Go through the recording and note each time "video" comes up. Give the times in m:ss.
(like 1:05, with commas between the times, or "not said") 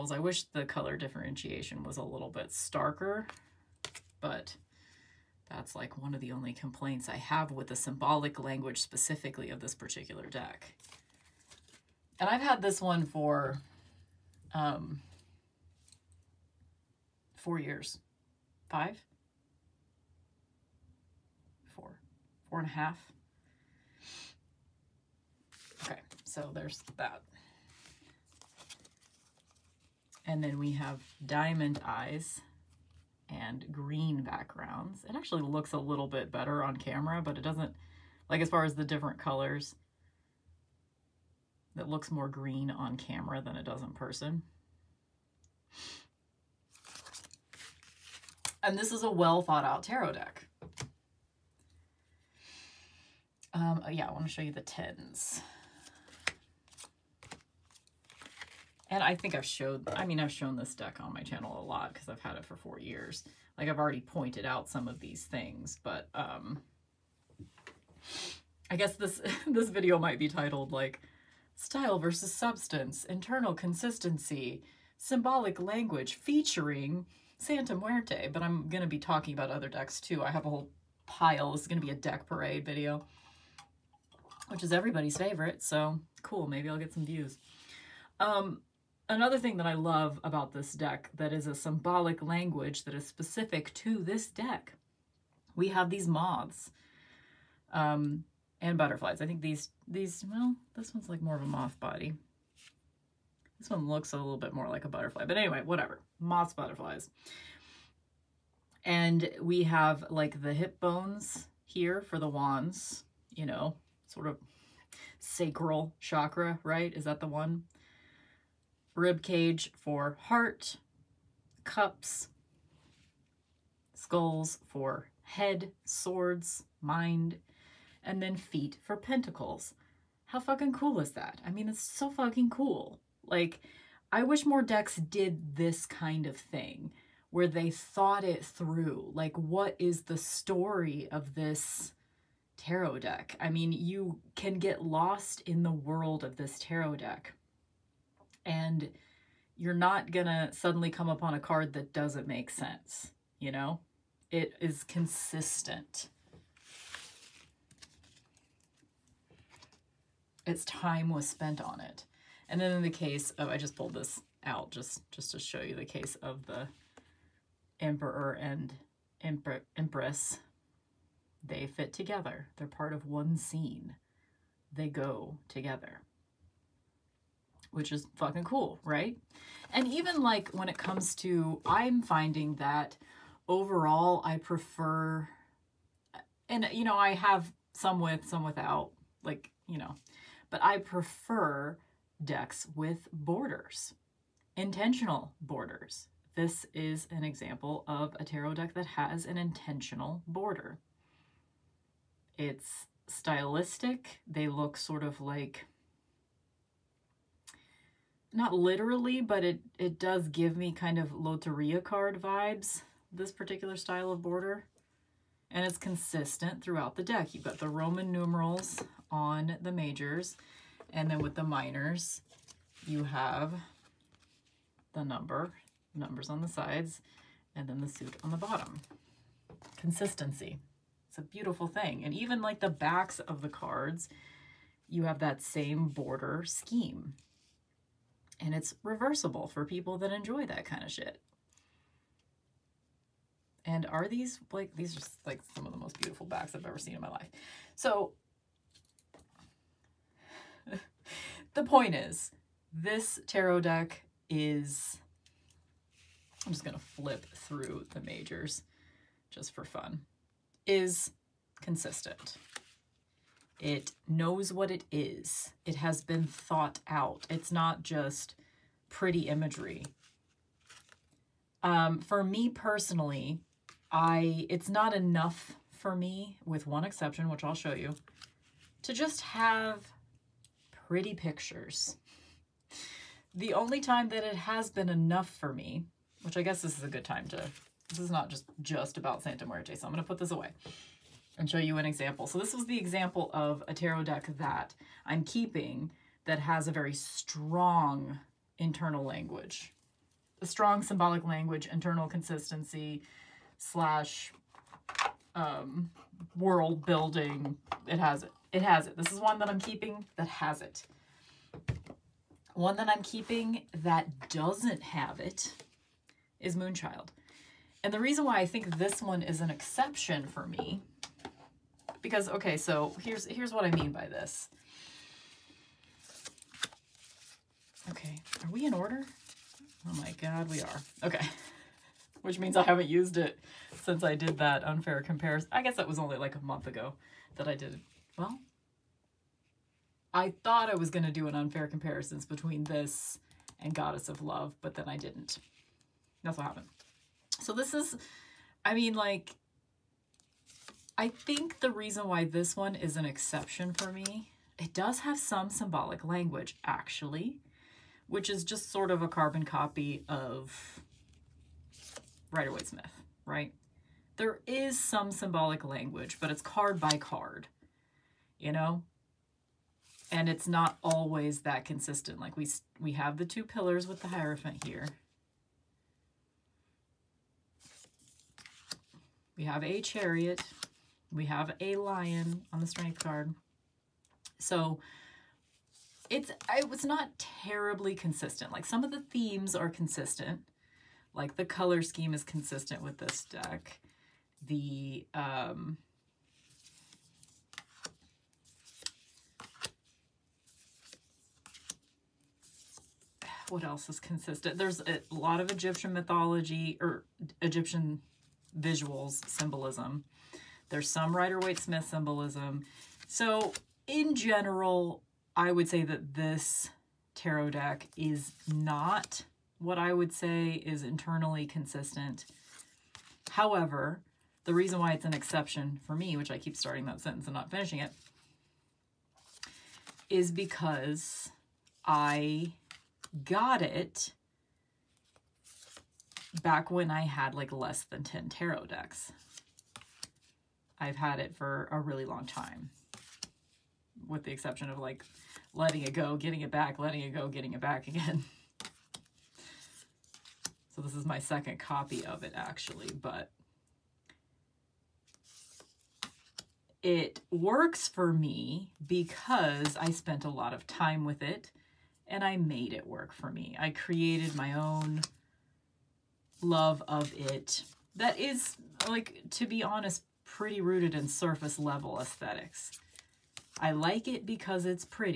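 1:09, 1:22.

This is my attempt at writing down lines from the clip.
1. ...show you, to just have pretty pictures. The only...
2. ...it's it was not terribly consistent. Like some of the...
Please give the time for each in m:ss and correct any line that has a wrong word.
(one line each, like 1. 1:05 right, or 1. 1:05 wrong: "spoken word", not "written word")
1. 4:37 right
2. 6:26 right.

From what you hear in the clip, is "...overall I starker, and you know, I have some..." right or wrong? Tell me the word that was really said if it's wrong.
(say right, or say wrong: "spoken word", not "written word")
wrong: "prefer", not "starker".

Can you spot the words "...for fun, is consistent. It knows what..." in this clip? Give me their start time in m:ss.
4:19.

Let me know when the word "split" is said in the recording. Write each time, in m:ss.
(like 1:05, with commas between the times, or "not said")
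not said.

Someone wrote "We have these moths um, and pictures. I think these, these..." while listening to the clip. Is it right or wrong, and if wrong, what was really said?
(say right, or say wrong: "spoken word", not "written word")
wrong: "butterflies", not "pictures".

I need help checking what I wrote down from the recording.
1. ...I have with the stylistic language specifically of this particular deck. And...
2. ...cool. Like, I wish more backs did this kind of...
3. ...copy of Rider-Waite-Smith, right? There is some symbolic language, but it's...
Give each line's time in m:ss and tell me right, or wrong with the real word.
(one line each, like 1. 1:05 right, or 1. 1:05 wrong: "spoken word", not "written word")
1. 0:07 wrong: "symbolic", not "stylistic"
2. 2:12 wrong: "decks", not "backs"
3. 5:59 right.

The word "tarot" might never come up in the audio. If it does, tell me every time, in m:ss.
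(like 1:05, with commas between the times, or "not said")
0:49, 2:22, 2:26, 3:18, 4:13, 4:53, 6:57, 7:18.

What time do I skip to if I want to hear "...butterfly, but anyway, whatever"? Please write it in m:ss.
1:44.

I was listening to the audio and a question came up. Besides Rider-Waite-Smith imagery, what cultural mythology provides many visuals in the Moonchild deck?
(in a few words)
Egyptian mythology.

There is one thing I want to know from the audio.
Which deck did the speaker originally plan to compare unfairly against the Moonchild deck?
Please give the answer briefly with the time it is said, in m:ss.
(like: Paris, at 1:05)
Goddess of Love, at 5:43.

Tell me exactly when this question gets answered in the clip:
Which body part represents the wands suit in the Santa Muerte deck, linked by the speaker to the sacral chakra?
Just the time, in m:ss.
1:50.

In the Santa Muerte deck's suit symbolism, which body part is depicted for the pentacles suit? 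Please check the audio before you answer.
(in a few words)
Feet.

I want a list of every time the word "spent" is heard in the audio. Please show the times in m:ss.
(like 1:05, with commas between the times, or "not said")
2:41, 7:39.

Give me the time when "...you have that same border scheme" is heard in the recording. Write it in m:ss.
3:54.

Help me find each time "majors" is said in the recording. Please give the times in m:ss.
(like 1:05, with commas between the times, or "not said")
3:39, 4:18.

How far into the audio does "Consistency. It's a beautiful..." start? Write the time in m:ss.
3:49.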